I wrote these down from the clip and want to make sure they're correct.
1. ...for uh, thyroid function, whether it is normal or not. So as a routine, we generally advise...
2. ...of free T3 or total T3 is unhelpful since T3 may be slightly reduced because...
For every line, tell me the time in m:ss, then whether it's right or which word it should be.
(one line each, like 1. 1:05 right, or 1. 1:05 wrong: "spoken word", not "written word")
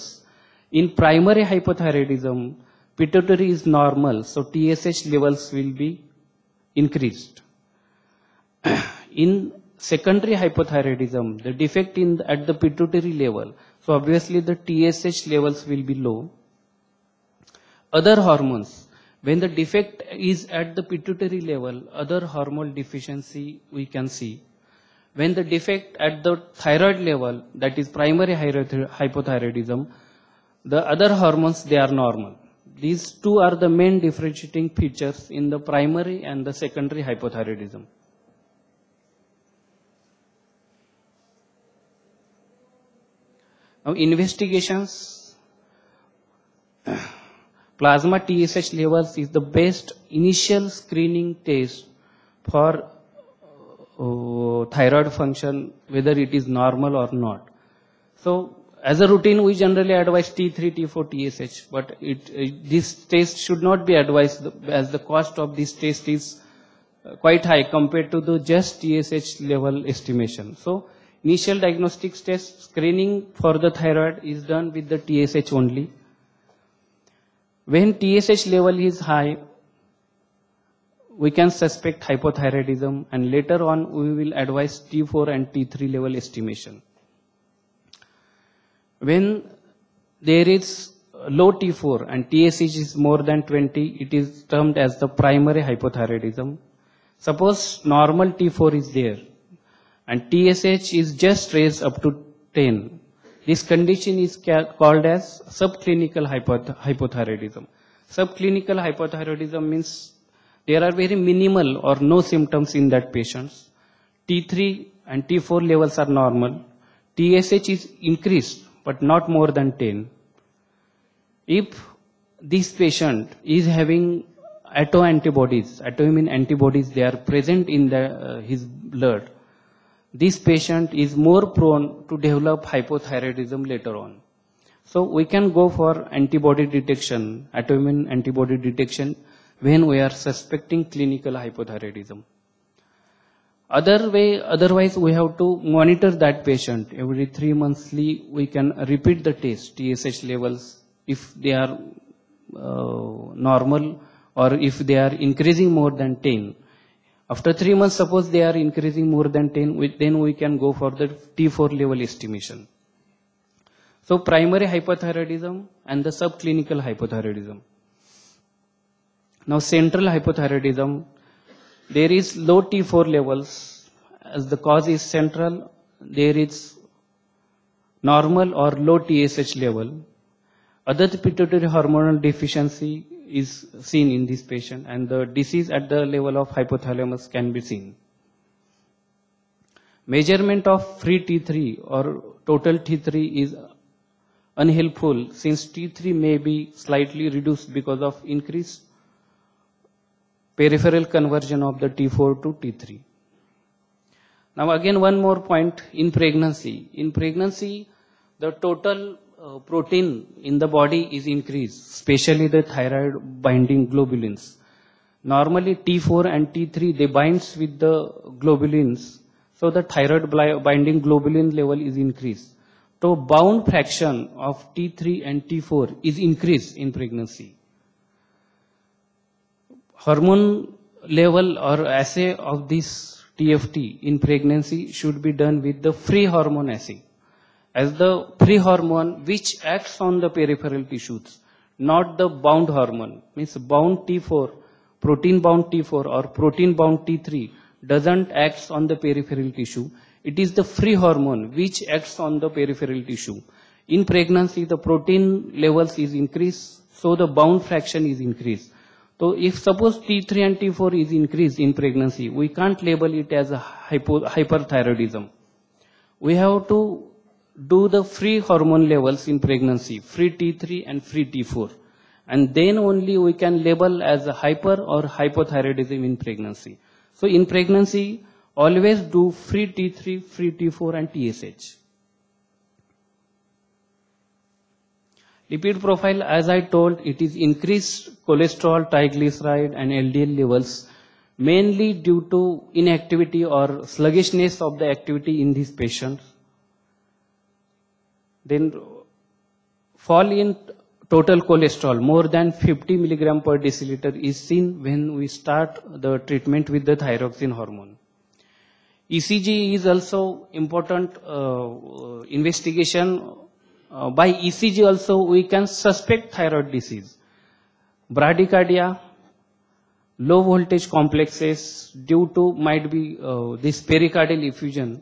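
1. 0:52 right
2. 3:10 right.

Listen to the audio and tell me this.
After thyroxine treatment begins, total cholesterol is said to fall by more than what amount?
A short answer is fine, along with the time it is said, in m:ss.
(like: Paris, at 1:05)
50 mg/dL, at 5:02.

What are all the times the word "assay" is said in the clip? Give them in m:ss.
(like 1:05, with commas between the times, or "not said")
3:51, 3:56.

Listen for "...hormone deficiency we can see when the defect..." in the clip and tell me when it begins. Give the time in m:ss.
0:22.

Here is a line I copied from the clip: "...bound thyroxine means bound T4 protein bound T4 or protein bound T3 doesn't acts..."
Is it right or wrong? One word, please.
wrong.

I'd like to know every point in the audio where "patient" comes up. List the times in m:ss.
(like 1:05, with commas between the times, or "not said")
1:53, 2:02, 2:10, 2:26, 3:04, 4:55.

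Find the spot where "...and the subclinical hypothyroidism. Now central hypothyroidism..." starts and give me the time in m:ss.
2:45.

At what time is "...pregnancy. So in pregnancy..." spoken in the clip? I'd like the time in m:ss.
4:36.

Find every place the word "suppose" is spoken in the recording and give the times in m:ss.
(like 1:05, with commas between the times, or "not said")
1:37, 2:38, 4:19.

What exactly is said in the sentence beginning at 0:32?
These two are the main differentiating features in the primary and the secondary hypothyroidism.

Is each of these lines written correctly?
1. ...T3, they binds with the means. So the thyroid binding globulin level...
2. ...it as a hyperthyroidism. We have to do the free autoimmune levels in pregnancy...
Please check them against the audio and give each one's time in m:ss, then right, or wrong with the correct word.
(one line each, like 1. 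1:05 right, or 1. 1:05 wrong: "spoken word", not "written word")
1. 3:36 wrong: "globulins", not "means"
2. 4:23 wrong: "hormone", not "autoimmune".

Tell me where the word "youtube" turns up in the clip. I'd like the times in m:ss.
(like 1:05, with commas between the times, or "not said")
not said.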